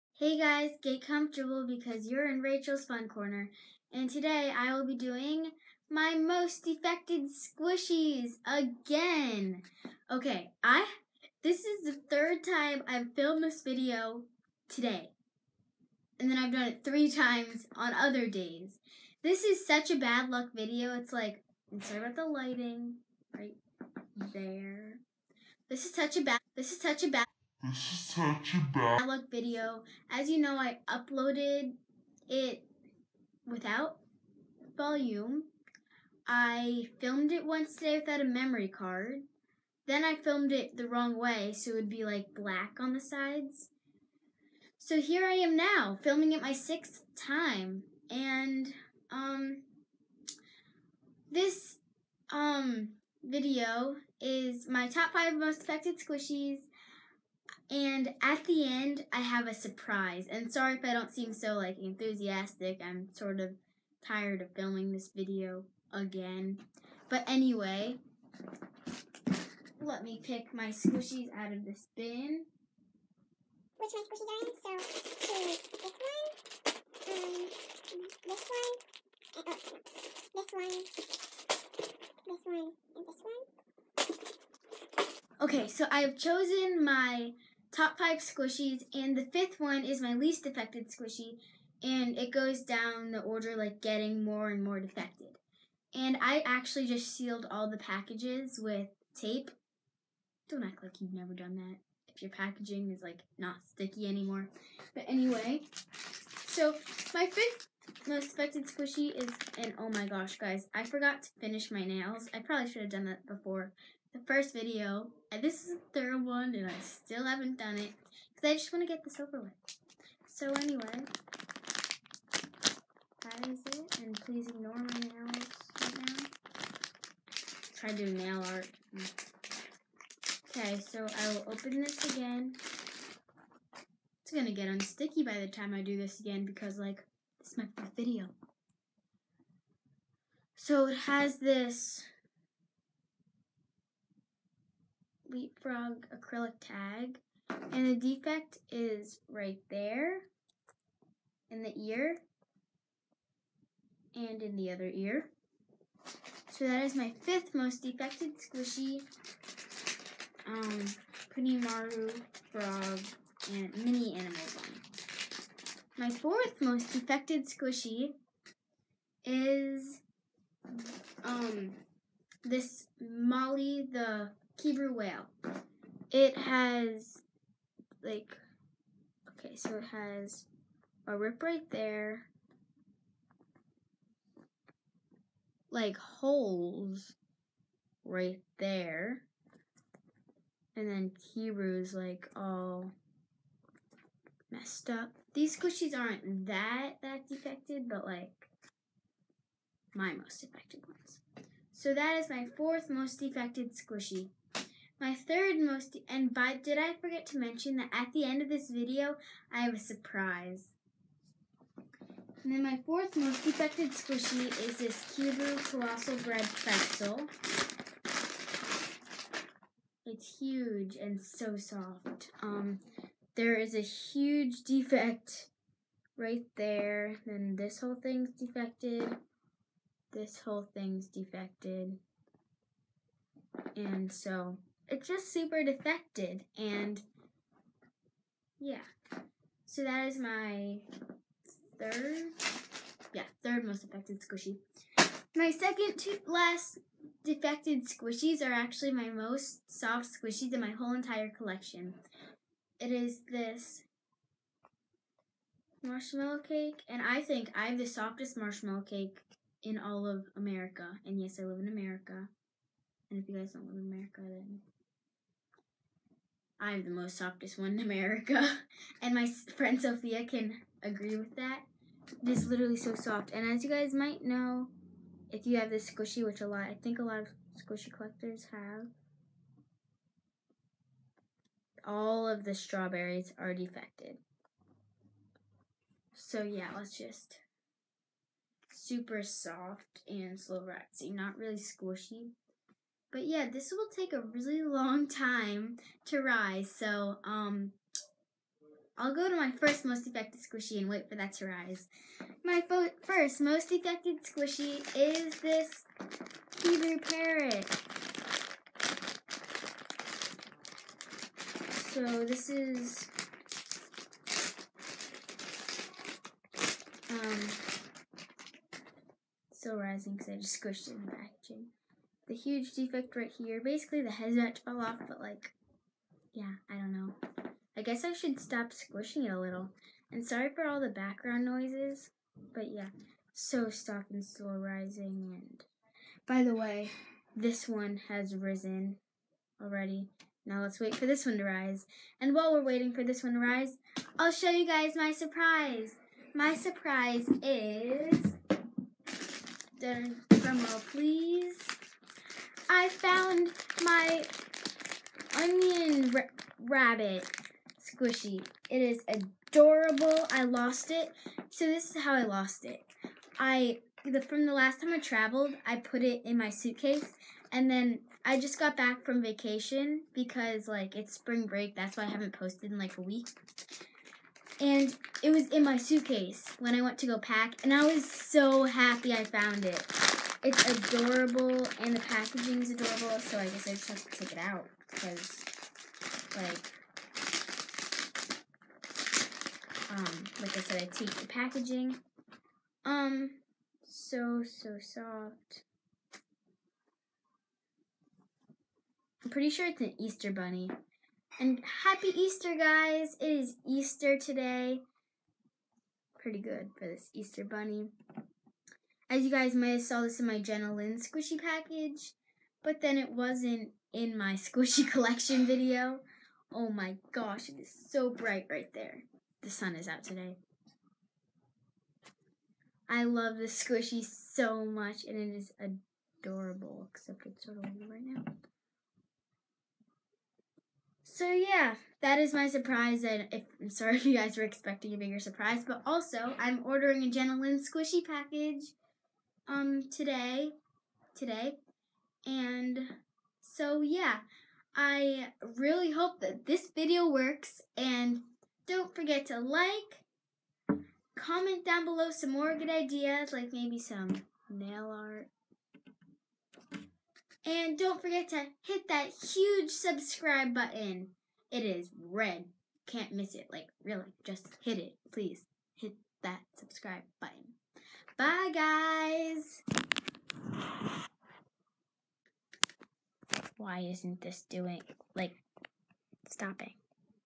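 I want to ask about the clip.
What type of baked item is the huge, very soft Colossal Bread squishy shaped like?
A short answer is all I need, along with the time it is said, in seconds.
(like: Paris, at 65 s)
Pretzel, at 216 s.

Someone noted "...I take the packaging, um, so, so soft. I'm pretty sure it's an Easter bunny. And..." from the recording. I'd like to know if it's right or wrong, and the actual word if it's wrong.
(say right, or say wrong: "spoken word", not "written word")
right.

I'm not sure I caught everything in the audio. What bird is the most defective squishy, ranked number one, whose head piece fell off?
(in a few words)
Parrot.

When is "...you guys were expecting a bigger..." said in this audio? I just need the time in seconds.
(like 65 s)
434 s.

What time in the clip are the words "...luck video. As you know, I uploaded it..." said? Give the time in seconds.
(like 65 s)
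29 s.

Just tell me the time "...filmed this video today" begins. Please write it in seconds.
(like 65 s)
13 s.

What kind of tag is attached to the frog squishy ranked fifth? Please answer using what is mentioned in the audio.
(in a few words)
Leapfrog acrylic tag.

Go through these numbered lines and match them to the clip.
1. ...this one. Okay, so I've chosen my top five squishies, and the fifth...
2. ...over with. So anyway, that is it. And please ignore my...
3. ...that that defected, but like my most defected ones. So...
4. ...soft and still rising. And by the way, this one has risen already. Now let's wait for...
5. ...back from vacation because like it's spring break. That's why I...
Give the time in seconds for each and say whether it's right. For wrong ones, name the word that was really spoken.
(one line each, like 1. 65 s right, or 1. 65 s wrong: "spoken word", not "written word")
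1. 83 s right
2. 119 s right
3. 196 s right
4. 333 s right
5. 368 s right.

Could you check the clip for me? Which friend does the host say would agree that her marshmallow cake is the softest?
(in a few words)
Sophia.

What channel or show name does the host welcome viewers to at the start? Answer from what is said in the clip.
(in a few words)
Rachel's Fun Corner.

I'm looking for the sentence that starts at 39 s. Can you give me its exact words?
Then I filmed it the wrong way, so it would be like black on the sides.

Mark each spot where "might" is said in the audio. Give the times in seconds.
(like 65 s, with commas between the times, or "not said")
273 s, 409 s.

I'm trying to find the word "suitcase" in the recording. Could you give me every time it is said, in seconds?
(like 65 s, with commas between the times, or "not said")
366 s, 375 s.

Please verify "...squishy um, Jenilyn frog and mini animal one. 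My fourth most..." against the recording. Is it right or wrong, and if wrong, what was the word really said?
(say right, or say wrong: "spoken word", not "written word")
wrong: "Punimaru", not "Jenilyn".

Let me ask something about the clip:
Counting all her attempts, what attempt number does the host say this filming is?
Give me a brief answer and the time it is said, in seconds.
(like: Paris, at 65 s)
6, at 46 s.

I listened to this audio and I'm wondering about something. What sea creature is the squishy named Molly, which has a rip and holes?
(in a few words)
Whale.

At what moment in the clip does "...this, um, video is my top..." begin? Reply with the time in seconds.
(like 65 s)
51 s.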